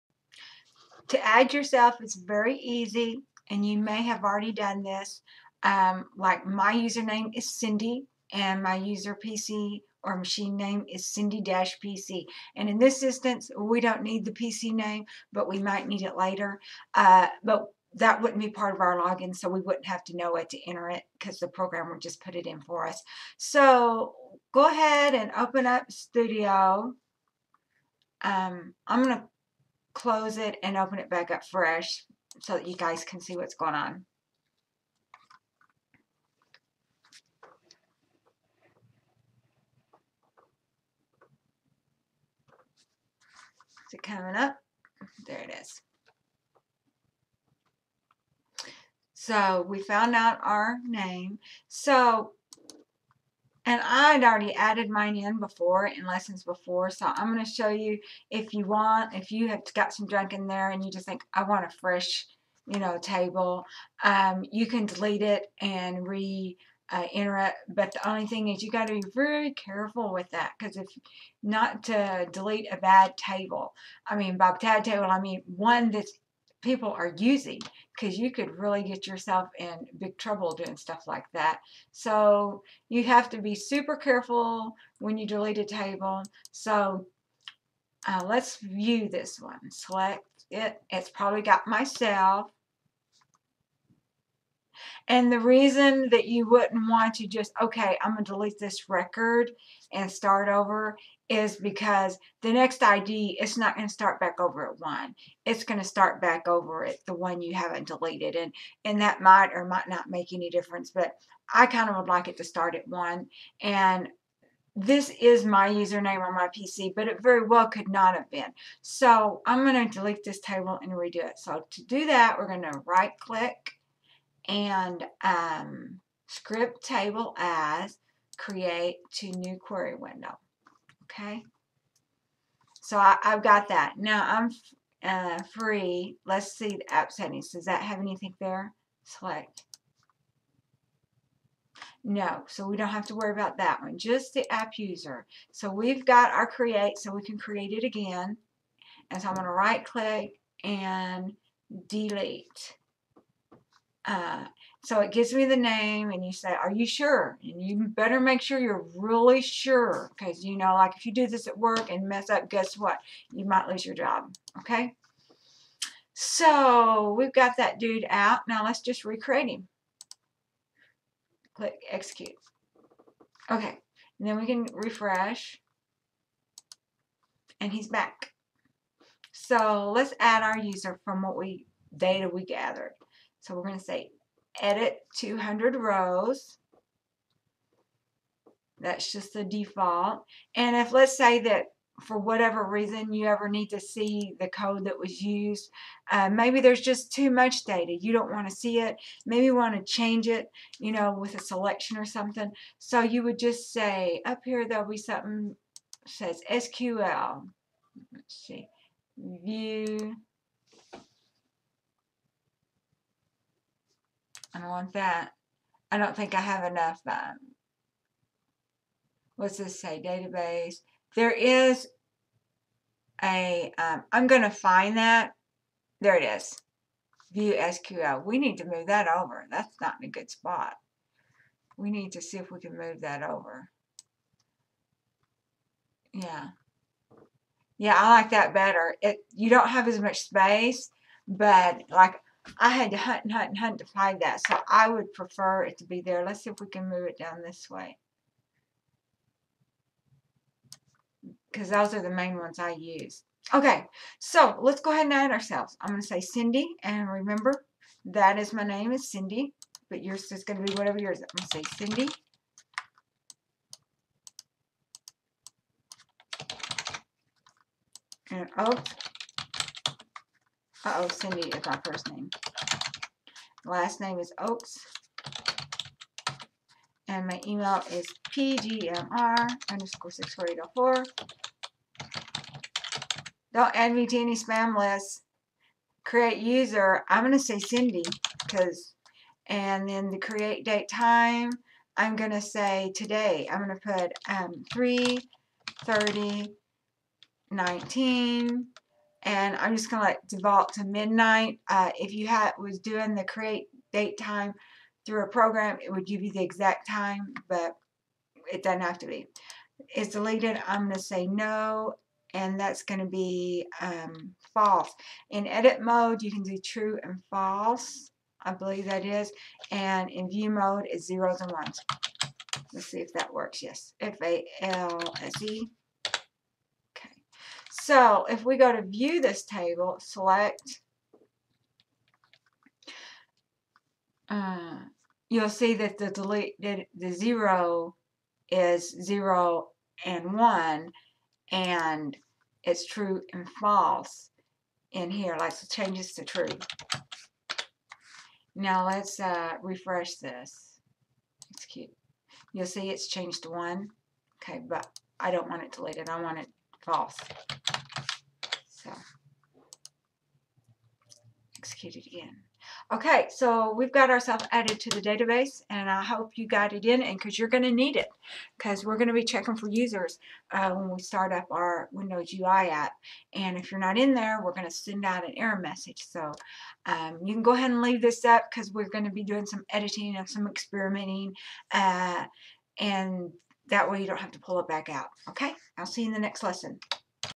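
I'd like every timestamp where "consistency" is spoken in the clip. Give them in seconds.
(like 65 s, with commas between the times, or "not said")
not said.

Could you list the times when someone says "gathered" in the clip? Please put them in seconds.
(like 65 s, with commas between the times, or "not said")
182 s.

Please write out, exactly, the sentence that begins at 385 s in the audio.
Okay, I'll see you in the next lesson.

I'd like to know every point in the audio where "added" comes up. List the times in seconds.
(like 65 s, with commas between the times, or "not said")
54 s, 364 s.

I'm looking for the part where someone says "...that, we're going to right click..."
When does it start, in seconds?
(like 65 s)
122 s.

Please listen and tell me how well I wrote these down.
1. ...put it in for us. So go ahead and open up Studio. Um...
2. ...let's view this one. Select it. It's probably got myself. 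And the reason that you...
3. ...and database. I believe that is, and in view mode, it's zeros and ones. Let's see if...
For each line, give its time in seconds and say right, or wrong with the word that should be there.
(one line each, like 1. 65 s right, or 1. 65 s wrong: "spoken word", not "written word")
1. 22 s right
2. 88 s right
3. 317 s wrong: "false", not "database".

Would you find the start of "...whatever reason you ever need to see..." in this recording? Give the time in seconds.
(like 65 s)
192 s.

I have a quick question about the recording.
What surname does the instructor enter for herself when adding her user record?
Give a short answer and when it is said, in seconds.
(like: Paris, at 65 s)
Oaks, at 274 s.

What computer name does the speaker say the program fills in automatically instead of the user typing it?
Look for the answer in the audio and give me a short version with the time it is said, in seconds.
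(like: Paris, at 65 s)
Cindy-PC, at 11 s.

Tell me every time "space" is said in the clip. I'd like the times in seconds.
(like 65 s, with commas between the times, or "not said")
240 s.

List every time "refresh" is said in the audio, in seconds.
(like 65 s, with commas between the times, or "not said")
174 s, 349 s.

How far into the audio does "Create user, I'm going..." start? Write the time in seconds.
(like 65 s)
286 s.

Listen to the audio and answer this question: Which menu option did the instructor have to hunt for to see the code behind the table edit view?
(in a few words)
View SQL.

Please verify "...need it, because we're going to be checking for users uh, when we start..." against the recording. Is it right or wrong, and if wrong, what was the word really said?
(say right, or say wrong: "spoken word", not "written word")
right.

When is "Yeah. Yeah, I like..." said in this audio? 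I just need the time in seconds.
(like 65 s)
236 s.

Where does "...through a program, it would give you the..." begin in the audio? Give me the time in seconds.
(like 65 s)
305 s.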